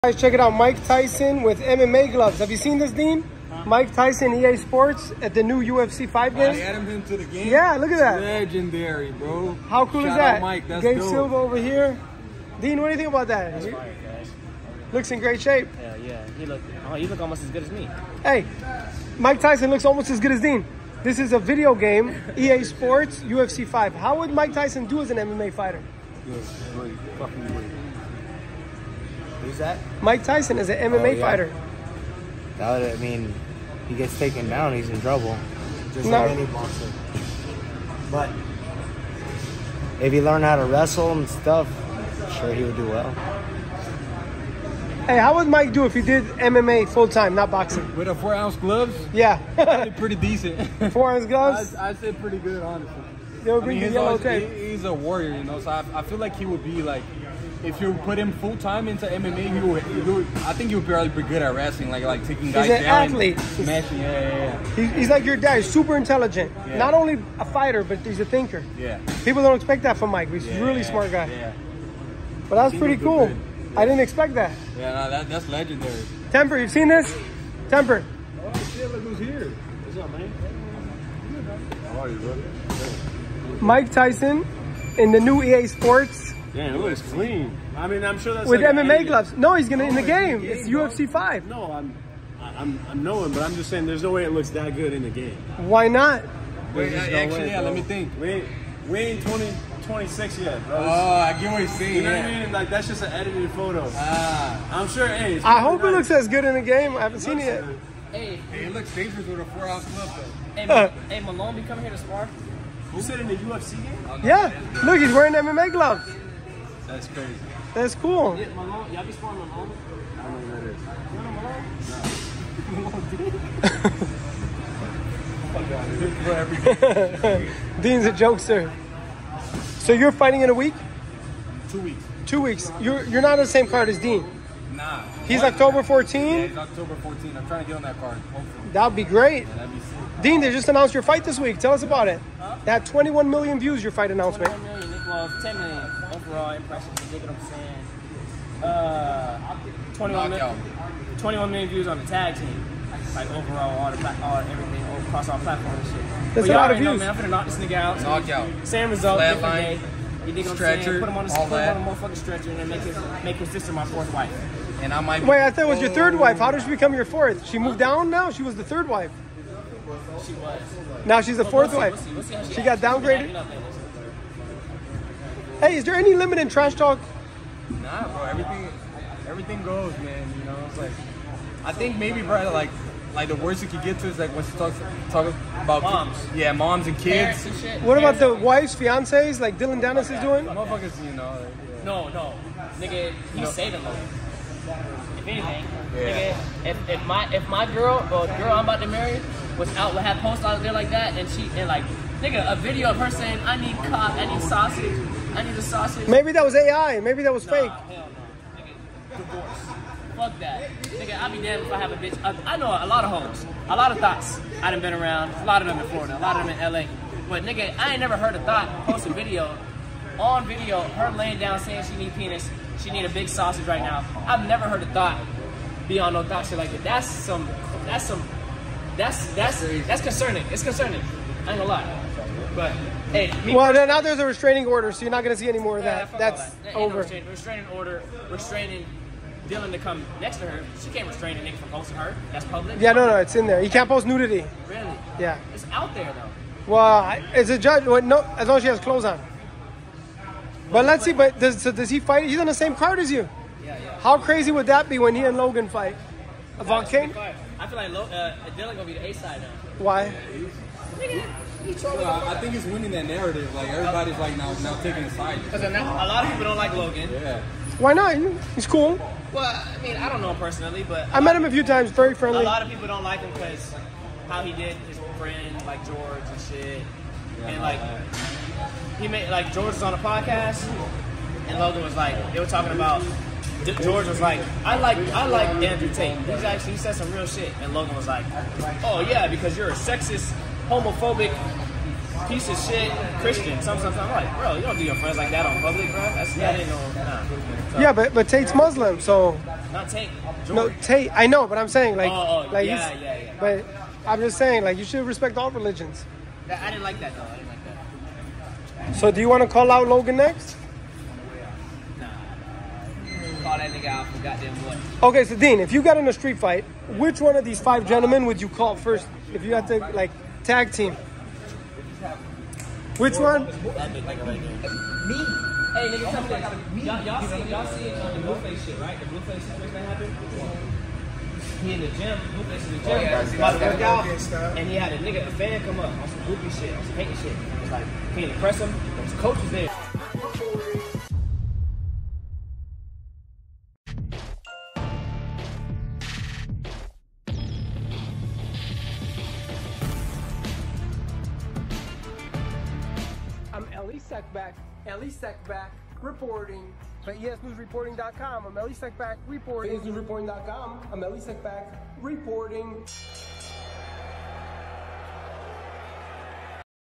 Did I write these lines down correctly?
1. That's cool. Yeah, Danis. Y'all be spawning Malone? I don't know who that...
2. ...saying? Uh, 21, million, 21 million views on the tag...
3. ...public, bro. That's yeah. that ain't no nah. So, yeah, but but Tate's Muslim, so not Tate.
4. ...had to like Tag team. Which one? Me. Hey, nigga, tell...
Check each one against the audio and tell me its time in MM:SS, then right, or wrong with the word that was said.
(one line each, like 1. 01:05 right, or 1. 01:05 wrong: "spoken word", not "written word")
1. 01:57 wrong: "Malone", not "Danis"
2. 02:27 right
3. 04:55 right
4. 05:19 right.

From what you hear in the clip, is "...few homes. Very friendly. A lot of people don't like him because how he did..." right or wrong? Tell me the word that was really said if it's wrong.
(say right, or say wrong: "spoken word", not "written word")
wrong: "times", not "homes".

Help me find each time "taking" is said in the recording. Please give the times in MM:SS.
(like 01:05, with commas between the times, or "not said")
01:02, 04:24.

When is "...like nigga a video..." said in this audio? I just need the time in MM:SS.
03:21.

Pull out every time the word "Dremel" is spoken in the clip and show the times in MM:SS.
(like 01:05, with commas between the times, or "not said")
not said.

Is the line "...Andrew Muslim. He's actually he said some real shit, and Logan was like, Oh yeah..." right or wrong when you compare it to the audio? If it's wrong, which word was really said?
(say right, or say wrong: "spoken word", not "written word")
wrong: "Tate", not "Muslim".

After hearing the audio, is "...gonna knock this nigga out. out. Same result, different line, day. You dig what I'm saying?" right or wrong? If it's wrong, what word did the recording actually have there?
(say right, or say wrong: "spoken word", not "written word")
right.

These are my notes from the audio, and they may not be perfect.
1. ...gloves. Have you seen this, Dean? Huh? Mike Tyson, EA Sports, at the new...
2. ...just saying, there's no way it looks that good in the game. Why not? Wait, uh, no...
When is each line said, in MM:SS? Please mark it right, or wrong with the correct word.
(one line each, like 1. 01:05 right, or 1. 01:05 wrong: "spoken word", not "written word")
1. 00:02 right
2. 01:33 right.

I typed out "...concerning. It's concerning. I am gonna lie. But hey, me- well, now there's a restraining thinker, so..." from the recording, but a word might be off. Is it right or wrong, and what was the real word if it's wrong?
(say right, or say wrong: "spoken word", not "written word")
wrong: "order", not "thinker".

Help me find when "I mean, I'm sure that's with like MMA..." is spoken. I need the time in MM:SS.
01:27.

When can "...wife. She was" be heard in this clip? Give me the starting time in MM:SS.
02:48.